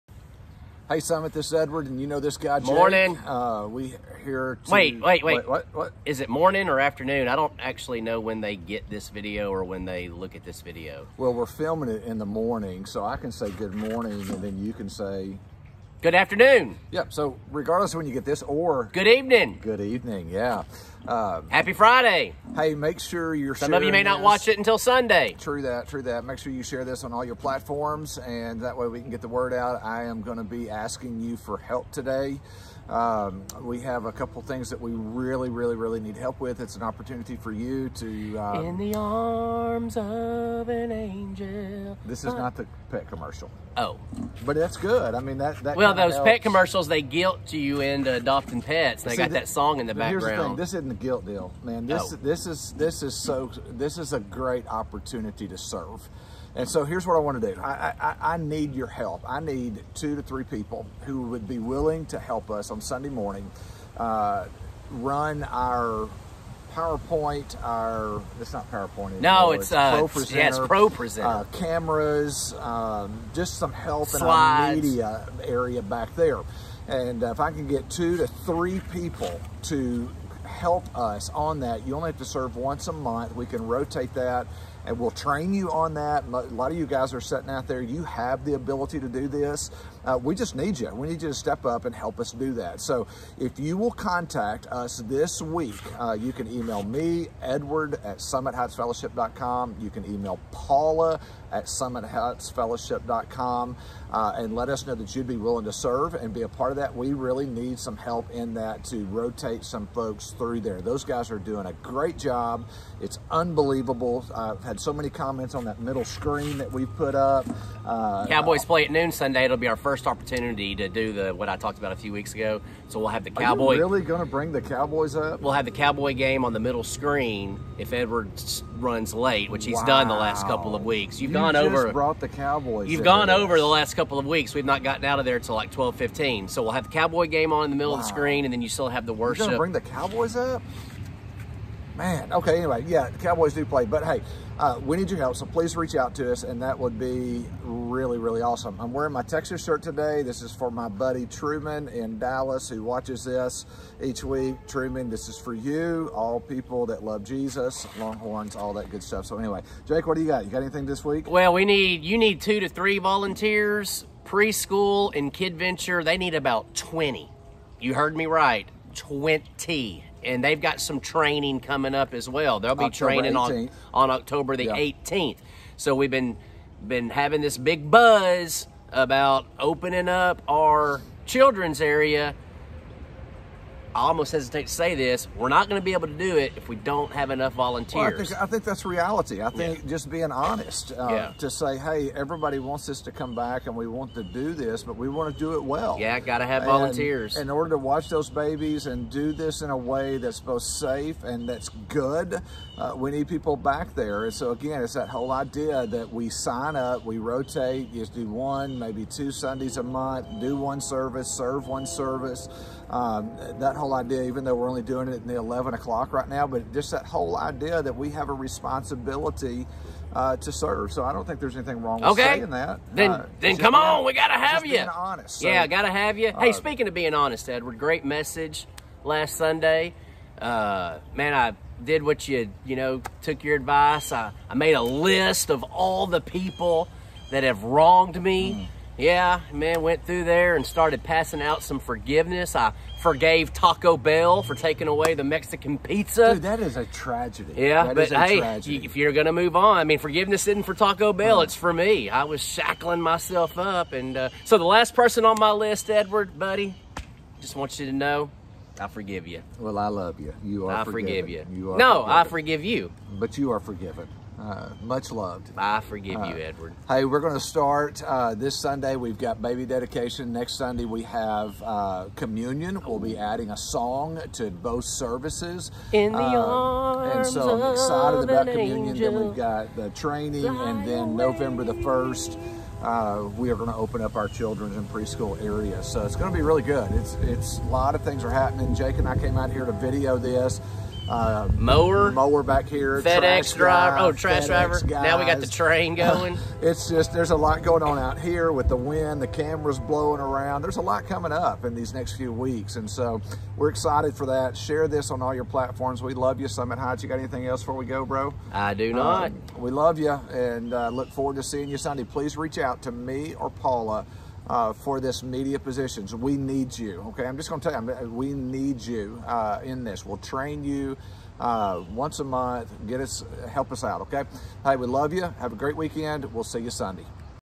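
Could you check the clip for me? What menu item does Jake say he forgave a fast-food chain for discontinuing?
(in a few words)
Mexican pizza.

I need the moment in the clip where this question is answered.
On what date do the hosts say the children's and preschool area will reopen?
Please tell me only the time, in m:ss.
4:41.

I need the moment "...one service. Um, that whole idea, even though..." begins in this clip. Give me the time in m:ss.
3:31.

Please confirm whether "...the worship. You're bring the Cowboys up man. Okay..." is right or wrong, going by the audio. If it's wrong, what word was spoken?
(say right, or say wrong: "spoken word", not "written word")
right.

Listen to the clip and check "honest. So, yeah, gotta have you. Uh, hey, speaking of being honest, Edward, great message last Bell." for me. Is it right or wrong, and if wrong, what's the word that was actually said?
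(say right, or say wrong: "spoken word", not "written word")
wrong: "Sunday", not "Bell".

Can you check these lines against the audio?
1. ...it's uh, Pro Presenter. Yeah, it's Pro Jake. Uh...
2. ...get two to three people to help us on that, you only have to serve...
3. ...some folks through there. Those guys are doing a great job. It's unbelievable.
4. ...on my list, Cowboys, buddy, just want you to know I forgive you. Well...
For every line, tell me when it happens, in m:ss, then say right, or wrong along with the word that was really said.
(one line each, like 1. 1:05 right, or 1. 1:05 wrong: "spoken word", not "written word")
1. 1:09 wrong: "Presenter", not "Jake"
2. 1:17 right
3. 1:49 right
4. 4:15 wrong: "Edward", not "Cowboys".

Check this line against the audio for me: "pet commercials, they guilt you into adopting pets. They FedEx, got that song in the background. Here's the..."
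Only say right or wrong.
wrong.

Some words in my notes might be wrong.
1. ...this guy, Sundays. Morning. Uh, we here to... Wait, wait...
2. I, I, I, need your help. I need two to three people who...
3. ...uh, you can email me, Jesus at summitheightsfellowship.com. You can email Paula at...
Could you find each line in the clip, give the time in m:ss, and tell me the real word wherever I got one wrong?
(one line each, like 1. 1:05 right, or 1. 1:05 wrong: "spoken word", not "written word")
1. 0:02 wrong: "Jake", not "Sundays"
2. 0:57 right
3. 1:35 wrong: "Edward", not "Jesus".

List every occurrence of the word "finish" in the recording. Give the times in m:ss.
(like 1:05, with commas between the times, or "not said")
not said.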